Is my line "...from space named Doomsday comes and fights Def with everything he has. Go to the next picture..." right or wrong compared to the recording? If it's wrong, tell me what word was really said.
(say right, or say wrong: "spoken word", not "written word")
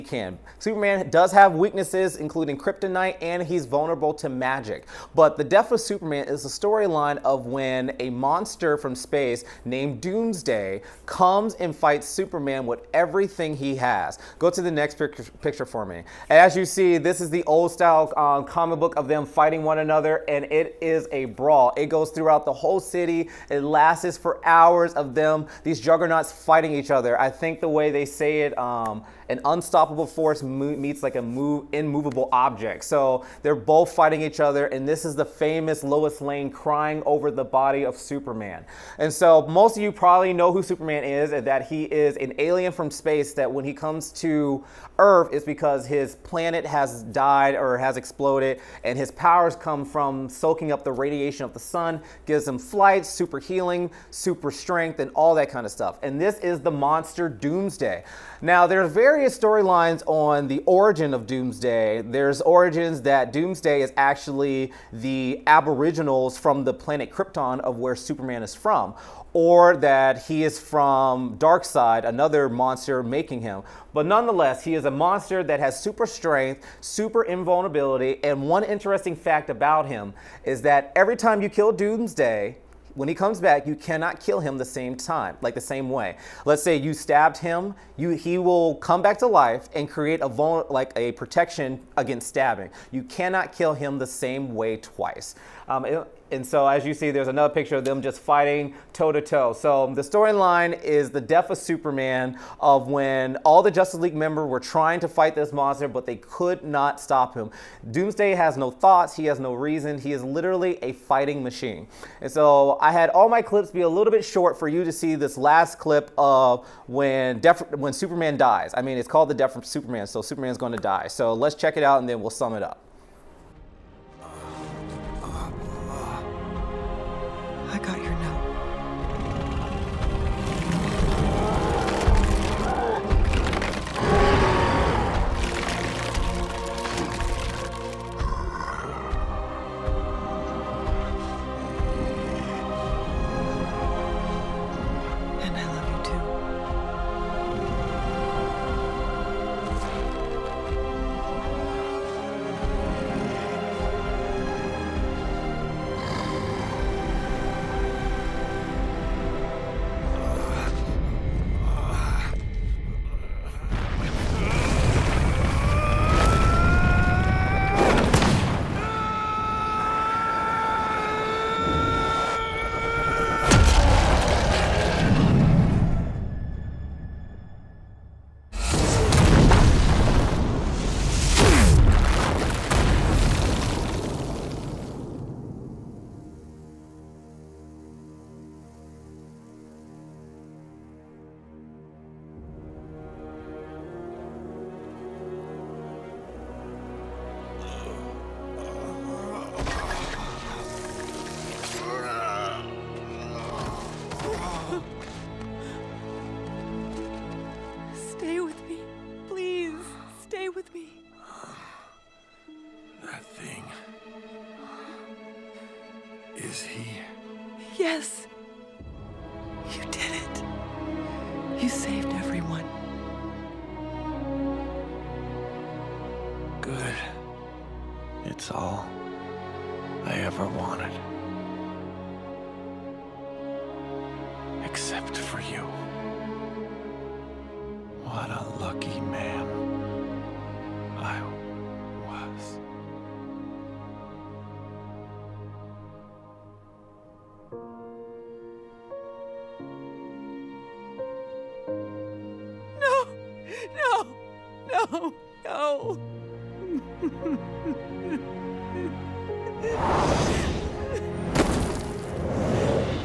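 wrong: "Superman", not "Def".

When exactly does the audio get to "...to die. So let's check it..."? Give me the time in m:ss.
2:00.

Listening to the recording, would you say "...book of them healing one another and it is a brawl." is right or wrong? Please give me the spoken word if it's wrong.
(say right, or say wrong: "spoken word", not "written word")
wrong: "fighting", not "healing".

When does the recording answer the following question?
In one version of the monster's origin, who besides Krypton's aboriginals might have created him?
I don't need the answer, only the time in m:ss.
1:11.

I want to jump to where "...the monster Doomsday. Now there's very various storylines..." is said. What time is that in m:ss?
0:56.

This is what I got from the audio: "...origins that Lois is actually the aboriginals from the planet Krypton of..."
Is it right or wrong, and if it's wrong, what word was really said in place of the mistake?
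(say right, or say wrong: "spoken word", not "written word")
wrong: "Doomsday", not "Lois".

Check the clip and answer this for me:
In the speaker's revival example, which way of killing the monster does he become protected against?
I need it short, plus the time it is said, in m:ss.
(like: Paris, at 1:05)
stabbing, at 1:32.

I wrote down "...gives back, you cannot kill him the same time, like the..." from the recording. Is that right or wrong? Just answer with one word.
wrong.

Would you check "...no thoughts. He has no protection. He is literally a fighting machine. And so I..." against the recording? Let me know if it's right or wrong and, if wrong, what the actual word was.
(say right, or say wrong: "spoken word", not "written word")
wrong: "reason", not "protection".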